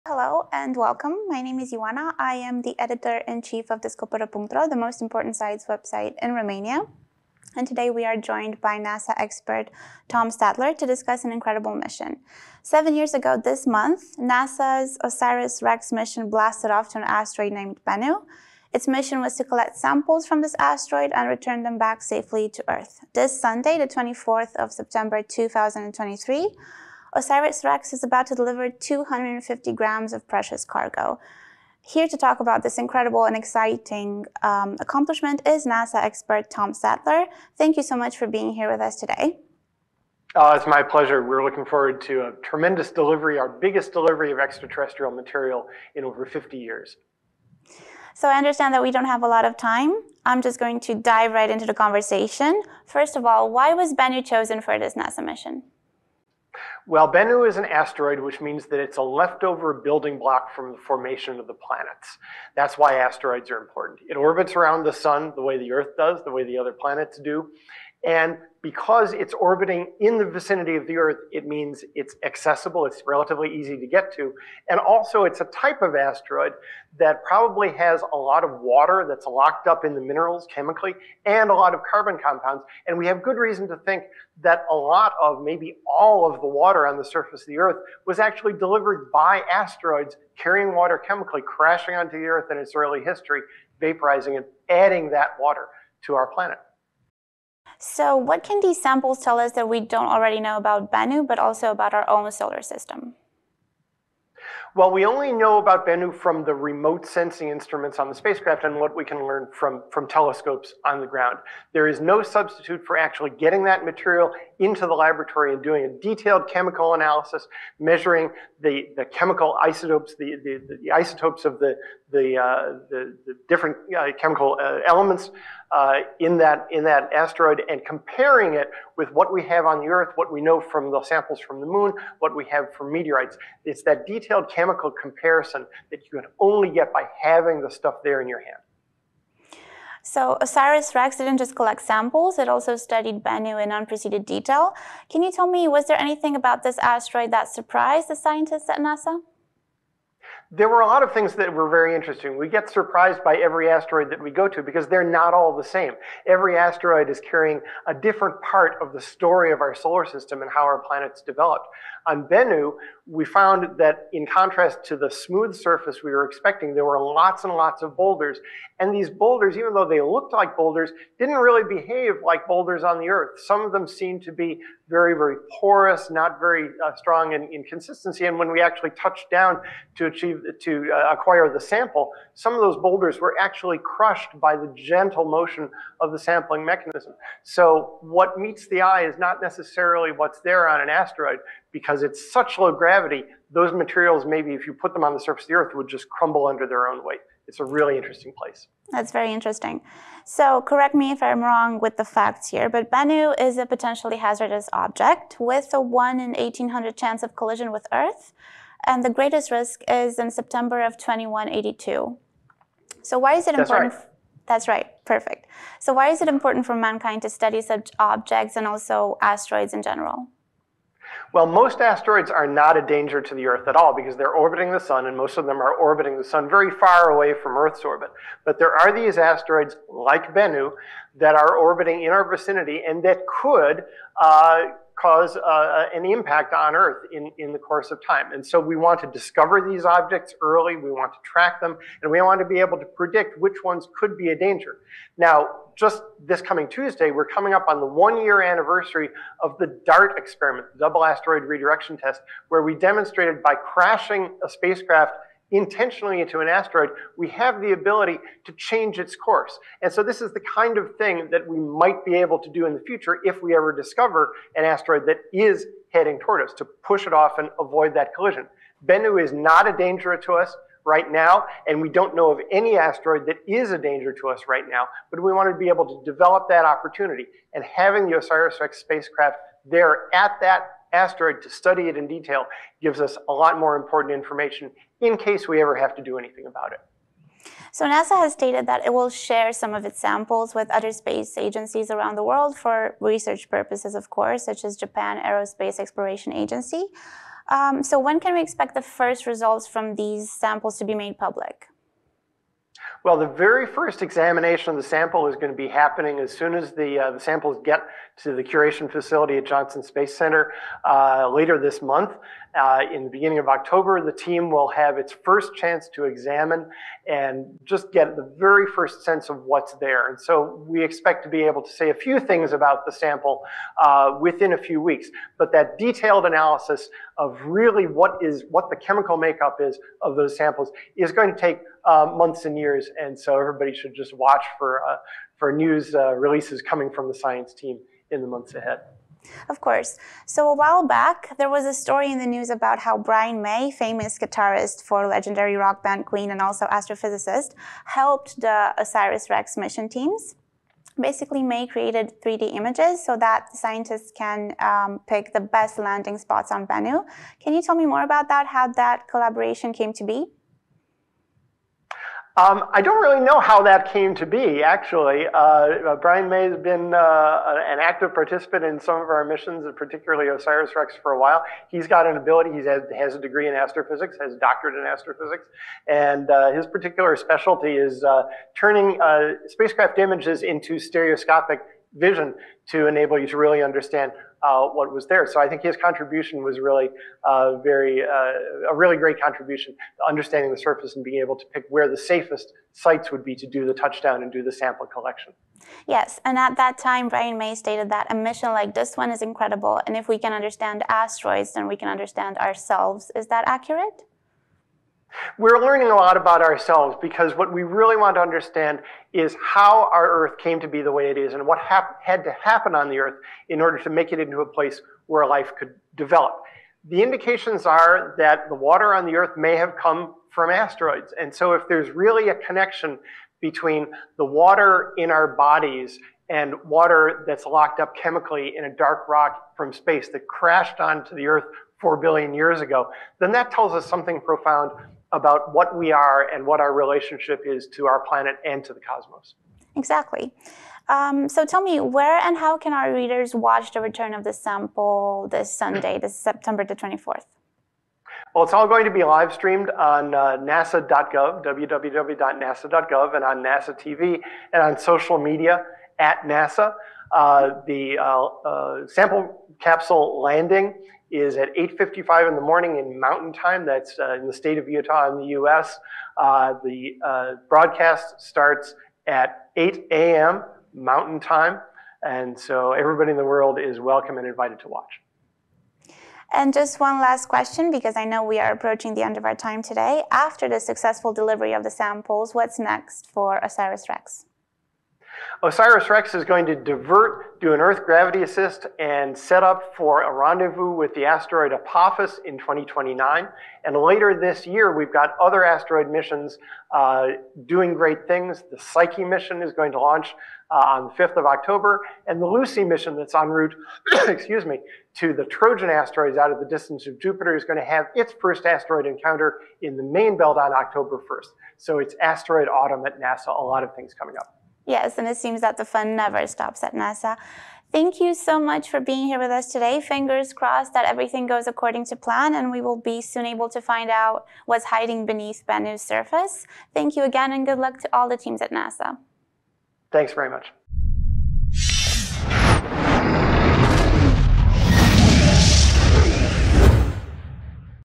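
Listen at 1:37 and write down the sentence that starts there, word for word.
So what can these samples tell us that we don't already know about Bennu, but also about our own solar system?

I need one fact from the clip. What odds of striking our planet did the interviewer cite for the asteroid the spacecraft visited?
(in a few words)
1 in 1800.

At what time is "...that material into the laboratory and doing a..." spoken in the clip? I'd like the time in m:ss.
1:53.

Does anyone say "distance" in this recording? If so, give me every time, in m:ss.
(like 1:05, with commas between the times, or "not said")
8:26.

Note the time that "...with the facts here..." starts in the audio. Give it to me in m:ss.
3:21.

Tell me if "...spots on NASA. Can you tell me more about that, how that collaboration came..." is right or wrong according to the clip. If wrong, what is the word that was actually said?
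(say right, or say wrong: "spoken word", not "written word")
wrong: "Bennu", not "NASA".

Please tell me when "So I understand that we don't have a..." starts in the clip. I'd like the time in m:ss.
0:48.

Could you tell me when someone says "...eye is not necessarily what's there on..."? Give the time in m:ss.
3:08.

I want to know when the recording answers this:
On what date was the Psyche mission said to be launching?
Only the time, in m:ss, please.
8:21.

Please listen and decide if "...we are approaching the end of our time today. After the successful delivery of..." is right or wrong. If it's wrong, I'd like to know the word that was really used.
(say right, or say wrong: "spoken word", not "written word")
right.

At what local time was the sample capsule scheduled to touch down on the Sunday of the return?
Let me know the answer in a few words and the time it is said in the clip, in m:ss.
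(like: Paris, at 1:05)
8:55 a.m. mountain time, at 7:41.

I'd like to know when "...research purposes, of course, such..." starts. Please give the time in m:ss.
4:52.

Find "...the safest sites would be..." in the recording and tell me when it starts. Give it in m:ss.
6:31.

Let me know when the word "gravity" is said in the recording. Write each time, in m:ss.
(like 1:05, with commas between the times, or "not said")
3:12, 8:07.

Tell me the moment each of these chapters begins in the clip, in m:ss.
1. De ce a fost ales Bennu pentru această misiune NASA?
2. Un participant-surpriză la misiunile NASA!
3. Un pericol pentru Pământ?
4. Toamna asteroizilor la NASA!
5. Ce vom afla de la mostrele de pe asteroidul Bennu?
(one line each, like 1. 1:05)
1. 0:55
2. 5:40
3. 3:20
4. 8:00
5. 1:40.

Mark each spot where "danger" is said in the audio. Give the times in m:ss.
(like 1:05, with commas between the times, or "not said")
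3:42, 4:04, 4:29, 4:33.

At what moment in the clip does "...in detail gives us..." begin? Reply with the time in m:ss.
4:41.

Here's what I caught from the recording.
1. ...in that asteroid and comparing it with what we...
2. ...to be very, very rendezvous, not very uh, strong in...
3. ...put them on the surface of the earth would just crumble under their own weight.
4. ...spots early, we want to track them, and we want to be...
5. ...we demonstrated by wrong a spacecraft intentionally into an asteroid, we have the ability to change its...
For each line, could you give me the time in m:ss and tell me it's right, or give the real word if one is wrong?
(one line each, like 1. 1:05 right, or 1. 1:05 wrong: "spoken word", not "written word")
1. 2:06 right
2. 2:54 wrong: "porous", not "rendezvous"
3. 3:14 right
4. 3:59 wrong: "objects", not "spots"
5. 4:12 wrong: "crashing", not "wrong".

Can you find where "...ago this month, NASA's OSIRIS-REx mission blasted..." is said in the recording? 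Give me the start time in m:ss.
0:13.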